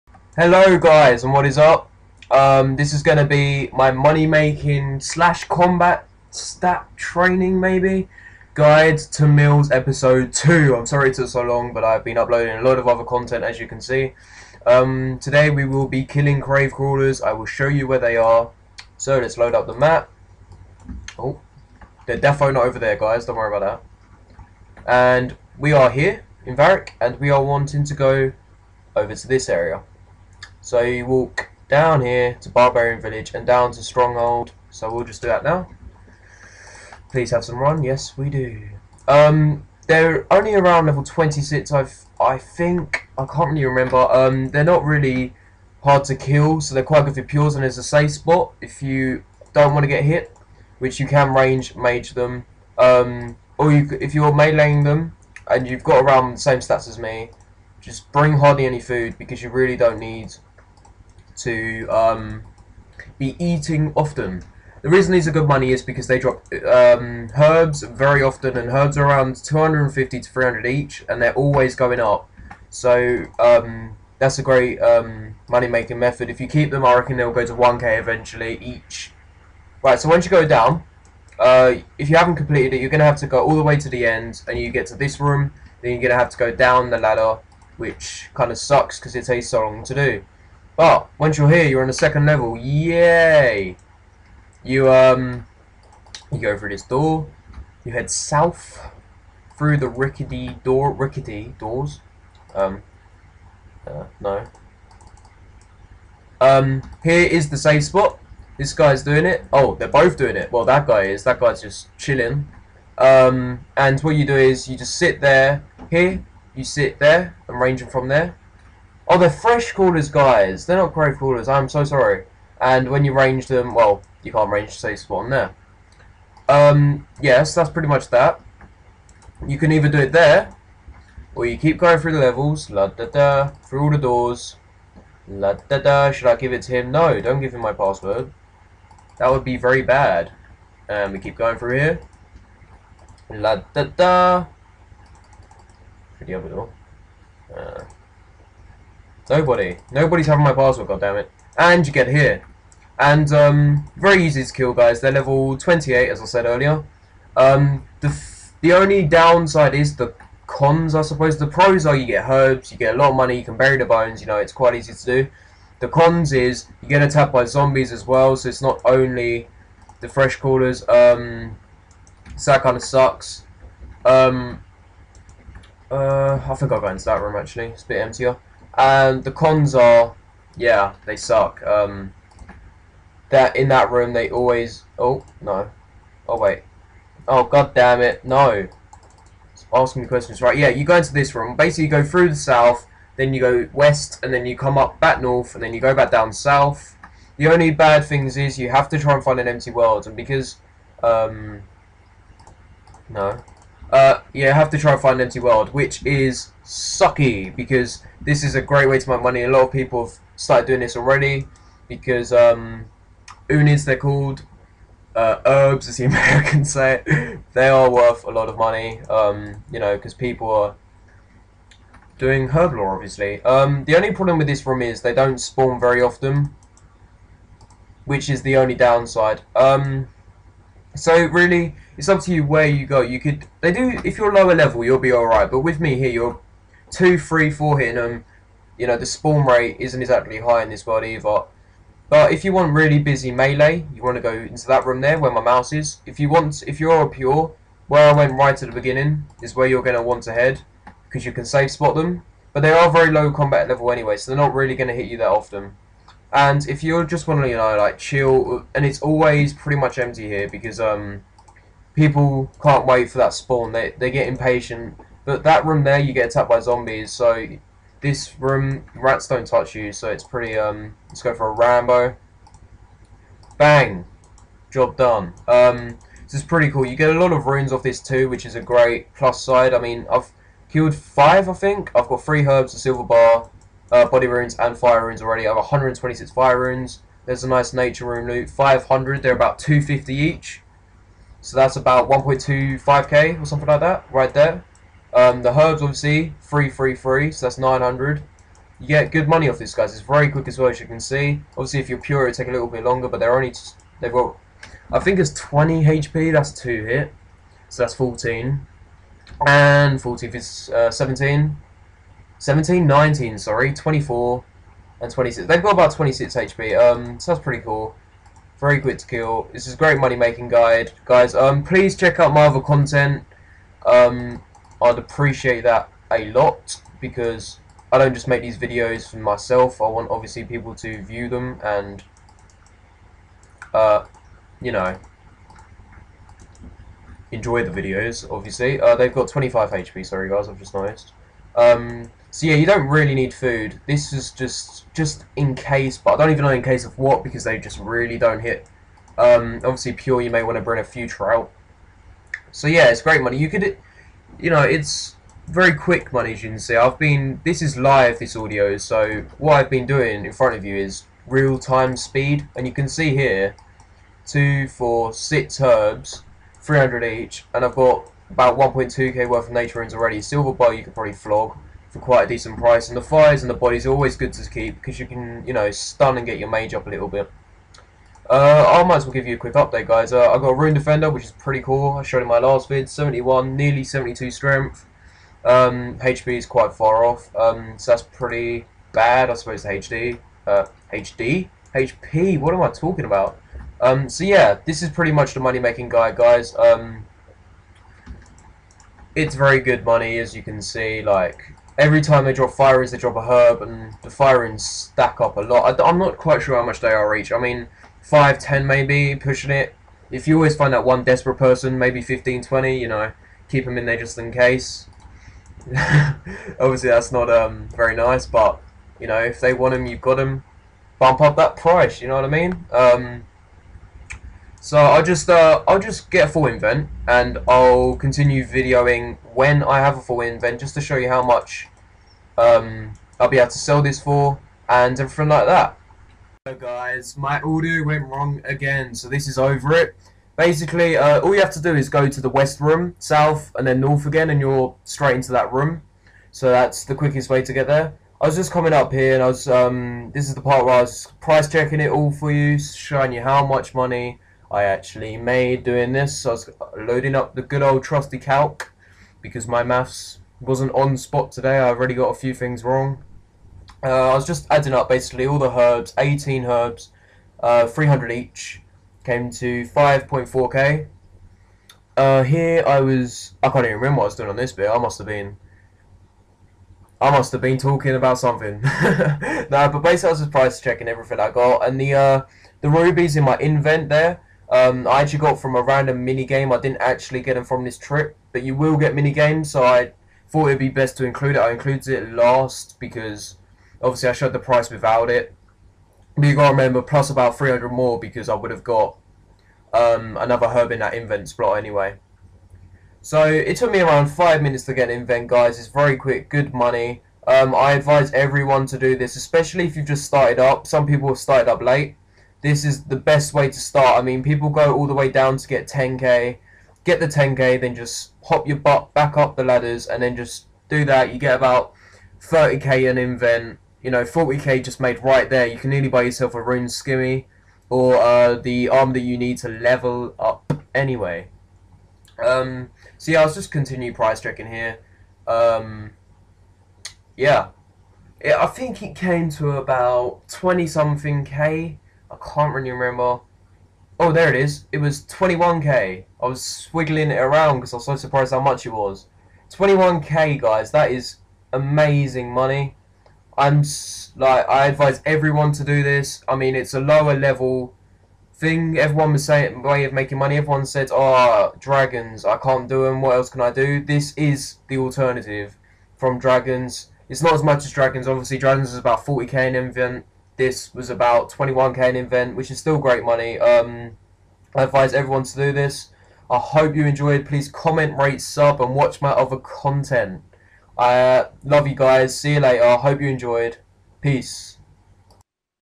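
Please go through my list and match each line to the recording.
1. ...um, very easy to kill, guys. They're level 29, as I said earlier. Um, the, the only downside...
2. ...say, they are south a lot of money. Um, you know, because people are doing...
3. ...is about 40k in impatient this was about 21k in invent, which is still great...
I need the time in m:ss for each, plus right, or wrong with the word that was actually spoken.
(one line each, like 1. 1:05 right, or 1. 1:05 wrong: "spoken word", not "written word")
1. 2:33 wrong: "28", not "29"
2. 3:36 wrong: "worth", not "south"
3. 9:28 wrong: "invent", not "impatient".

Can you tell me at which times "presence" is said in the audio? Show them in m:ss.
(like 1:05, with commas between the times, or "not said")
not said.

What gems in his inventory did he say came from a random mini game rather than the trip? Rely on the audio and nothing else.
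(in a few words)
rubies.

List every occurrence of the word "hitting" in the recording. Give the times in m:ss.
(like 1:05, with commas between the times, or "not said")
3:57.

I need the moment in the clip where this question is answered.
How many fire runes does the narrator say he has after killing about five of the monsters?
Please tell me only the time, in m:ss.
4:45.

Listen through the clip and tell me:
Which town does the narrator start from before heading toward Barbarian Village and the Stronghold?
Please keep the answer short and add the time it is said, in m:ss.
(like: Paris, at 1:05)
Varrock, at 0:26.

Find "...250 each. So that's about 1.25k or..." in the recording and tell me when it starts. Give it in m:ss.
4:49.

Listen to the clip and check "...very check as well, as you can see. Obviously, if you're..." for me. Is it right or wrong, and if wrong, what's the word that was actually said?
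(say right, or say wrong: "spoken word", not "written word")
wrong: "quick", not "check".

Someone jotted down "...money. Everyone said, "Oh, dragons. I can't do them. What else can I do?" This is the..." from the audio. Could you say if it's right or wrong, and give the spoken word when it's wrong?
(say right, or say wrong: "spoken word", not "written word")
right.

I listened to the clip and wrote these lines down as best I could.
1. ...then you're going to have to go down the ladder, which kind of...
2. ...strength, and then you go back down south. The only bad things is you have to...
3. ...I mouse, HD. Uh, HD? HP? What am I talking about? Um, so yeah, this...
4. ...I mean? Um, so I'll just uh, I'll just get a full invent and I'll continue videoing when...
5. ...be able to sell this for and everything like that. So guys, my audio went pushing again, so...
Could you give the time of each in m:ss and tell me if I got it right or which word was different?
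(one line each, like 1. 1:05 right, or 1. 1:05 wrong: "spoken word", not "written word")
1. 1:25 right
2. 3:15 wrong: "north", not "strength"
3. 6:29 wrong: "suppose", not "mouse"
4. 7:02 right
5. 7:13 wrong: "wrong", not "pushing".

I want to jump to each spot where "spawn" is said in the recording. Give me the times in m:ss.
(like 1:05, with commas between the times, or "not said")
2:04, 3:45, 3:59, 4:23.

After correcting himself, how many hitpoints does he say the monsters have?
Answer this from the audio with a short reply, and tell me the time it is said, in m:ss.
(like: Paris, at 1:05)
25, at 5:39.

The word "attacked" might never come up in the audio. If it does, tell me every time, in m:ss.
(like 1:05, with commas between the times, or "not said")
2:47, 4:26.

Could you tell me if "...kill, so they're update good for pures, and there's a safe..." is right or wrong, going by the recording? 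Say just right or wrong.
wrong.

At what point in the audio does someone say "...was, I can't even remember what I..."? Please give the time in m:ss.
7:52.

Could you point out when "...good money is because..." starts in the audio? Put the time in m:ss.
1:05.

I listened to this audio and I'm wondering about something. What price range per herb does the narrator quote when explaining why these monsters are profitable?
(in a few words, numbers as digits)
250 to 300.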